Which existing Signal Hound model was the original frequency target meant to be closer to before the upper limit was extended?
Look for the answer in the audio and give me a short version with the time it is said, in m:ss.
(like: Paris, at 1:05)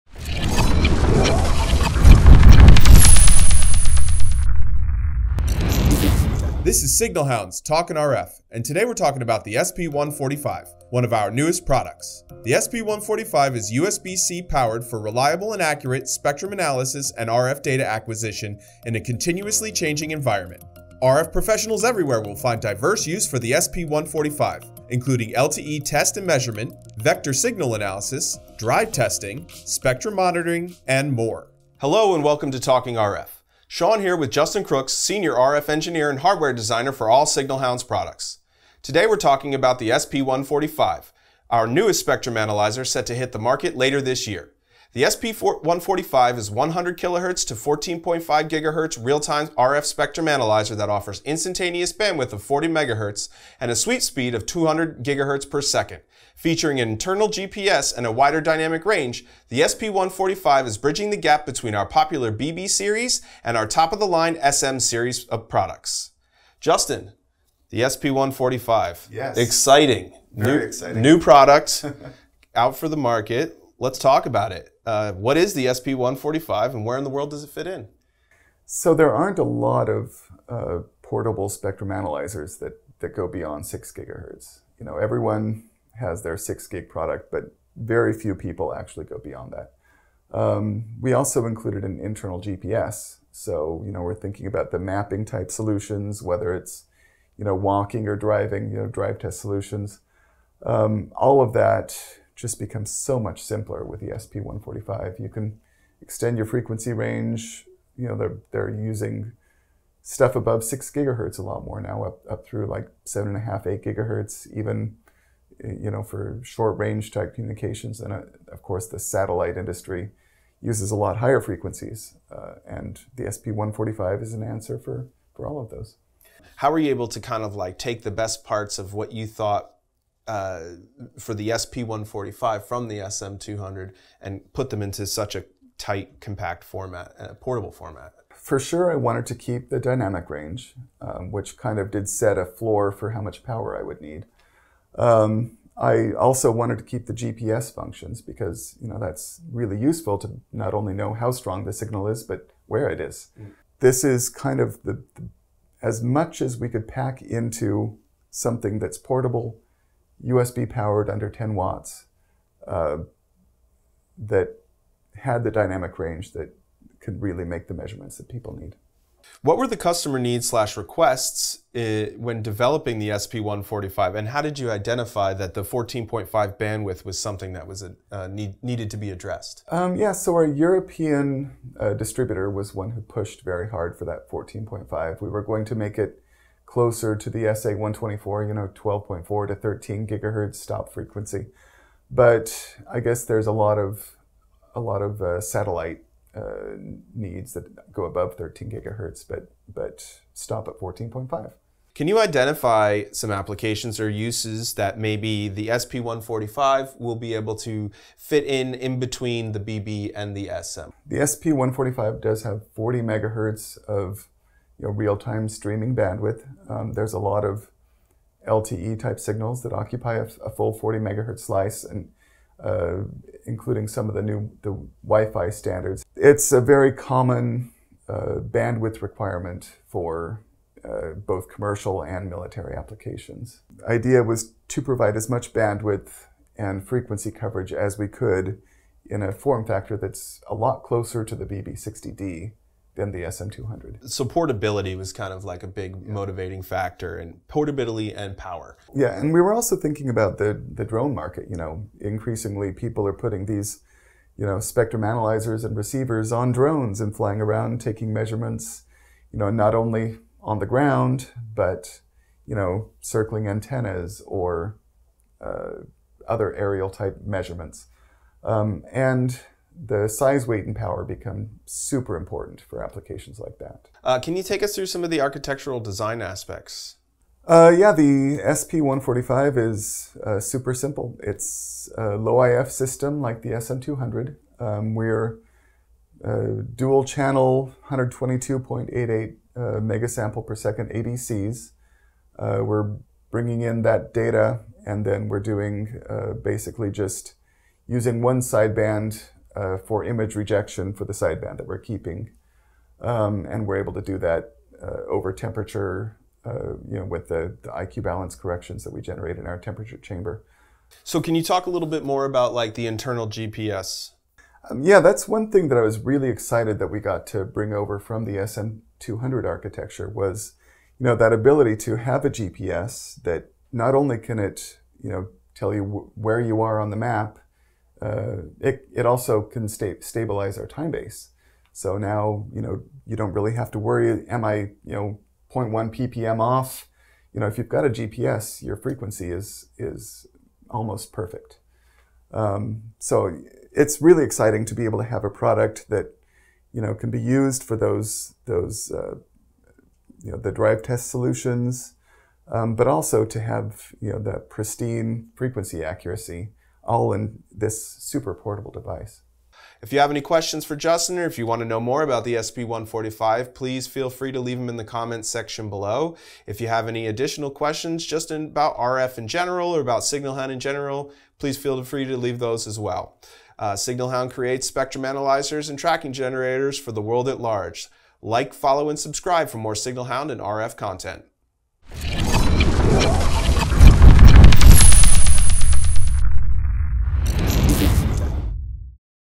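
SA124, at 3:07.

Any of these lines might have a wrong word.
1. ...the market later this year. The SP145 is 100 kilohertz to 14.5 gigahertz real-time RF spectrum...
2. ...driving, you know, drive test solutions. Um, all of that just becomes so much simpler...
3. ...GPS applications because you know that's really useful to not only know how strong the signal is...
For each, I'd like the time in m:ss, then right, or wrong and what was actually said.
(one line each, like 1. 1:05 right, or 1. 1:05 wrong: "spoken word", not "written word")
1. 0:43 right
2. 1:38 right
3. 2:27 wrong: "functions", not "applications".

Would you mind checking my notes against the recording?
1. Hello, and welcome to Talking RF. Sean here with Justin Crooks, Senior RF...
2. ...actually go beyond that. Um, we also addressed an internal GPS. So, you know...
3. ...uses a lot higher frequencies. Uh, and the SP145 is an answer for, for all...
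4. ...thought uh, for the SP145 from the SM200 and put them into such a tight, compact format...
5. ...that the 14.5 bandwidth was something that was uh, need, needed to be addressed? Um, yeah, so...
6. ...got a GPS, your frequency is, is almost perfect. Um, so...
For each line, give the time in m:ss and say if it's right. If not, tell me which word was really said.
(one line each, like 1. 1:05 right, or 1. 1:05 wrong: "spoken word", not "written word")
1. 0:31 right
2. 1:28 wrong: "included", not "addressed"
3. 2:00 right
4. 2:09 right
5. 2:55 right
6. 5:37 right.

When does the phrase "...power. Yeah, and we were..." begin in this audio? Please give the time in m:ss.
4:08.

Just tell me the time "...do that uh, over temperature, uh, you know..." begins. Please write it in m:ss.
5:04.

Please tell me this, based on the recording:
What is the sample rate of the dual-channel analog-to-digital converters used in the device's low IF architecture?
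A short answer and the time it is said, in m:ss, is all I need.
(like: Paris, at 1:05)
122.88 megasamples per second, at 4:47.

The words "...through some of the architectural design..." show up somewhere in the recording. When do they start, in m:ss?
4:34.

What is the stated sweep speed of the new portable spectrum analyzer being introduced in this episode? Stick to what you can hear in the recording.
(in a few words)
200 GHz per second.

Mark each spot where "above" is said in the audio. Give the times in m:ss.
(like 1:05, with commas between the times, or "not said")
1:50, 3:18.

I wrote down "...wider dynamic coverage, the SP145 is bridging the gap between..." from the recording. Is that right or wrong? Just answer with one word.
wrong.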